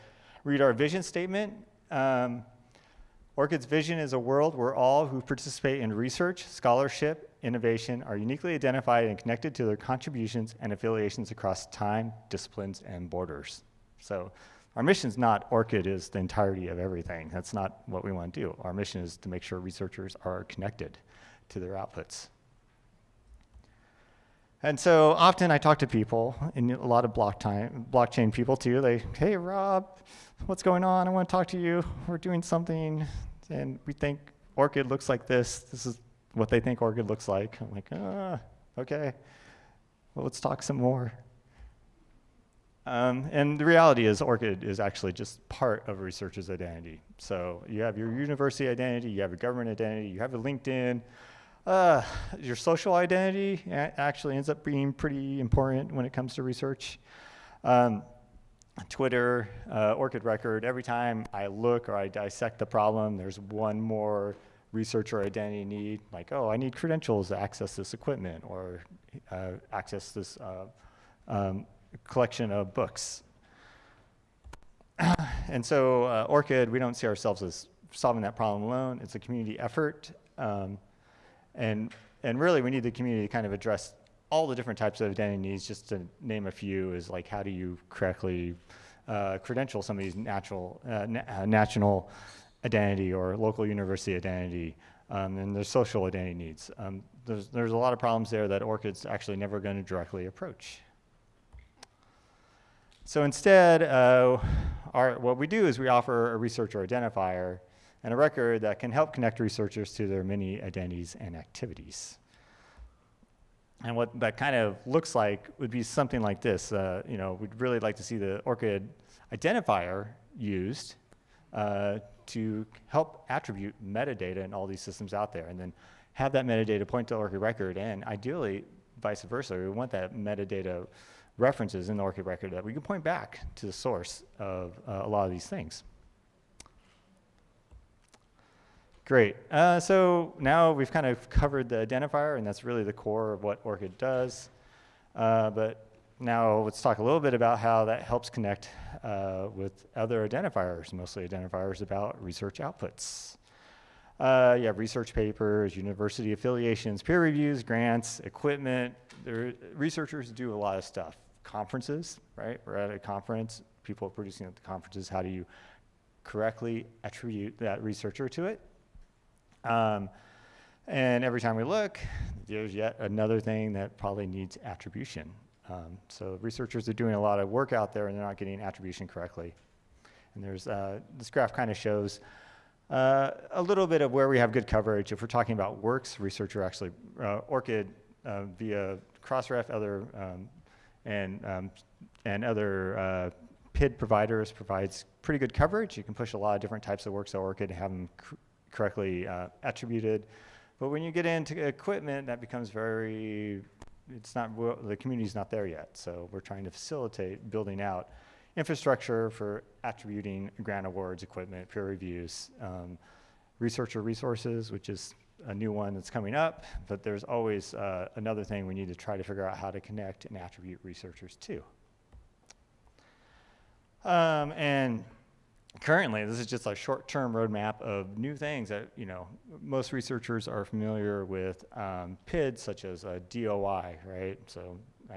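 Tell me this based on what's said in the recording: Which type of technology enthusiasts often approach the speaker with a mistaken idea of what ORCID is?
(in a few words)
blockchain people.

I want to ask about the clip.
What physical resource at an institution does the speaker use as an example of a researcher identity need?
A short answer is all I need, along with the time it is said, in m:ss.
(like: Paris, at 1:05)
collection of books, at 1:12.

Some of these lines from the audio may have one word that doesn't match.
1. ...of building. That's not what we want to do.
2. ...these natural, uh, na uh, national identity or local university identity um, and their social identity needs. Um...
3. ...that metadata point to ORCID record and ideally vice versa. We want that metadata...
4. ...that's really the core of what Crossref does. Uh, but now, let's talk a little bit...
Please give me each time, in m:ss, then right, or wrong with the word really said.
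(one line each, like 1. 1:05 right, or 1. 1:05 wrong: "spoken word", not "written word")
1. 0:16 wrong: "everything", not "building"
2. 1:30 right
3. 2:06 right
4. 2:22 wrong: "ORCID", not "Crossref".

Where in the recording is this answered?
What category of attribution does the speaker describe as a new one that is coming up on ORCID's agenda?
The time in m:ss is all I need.
3:33.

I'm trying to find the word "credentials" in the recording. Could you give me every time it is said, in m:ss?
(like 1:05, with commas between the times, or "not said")
1:06, 1:29.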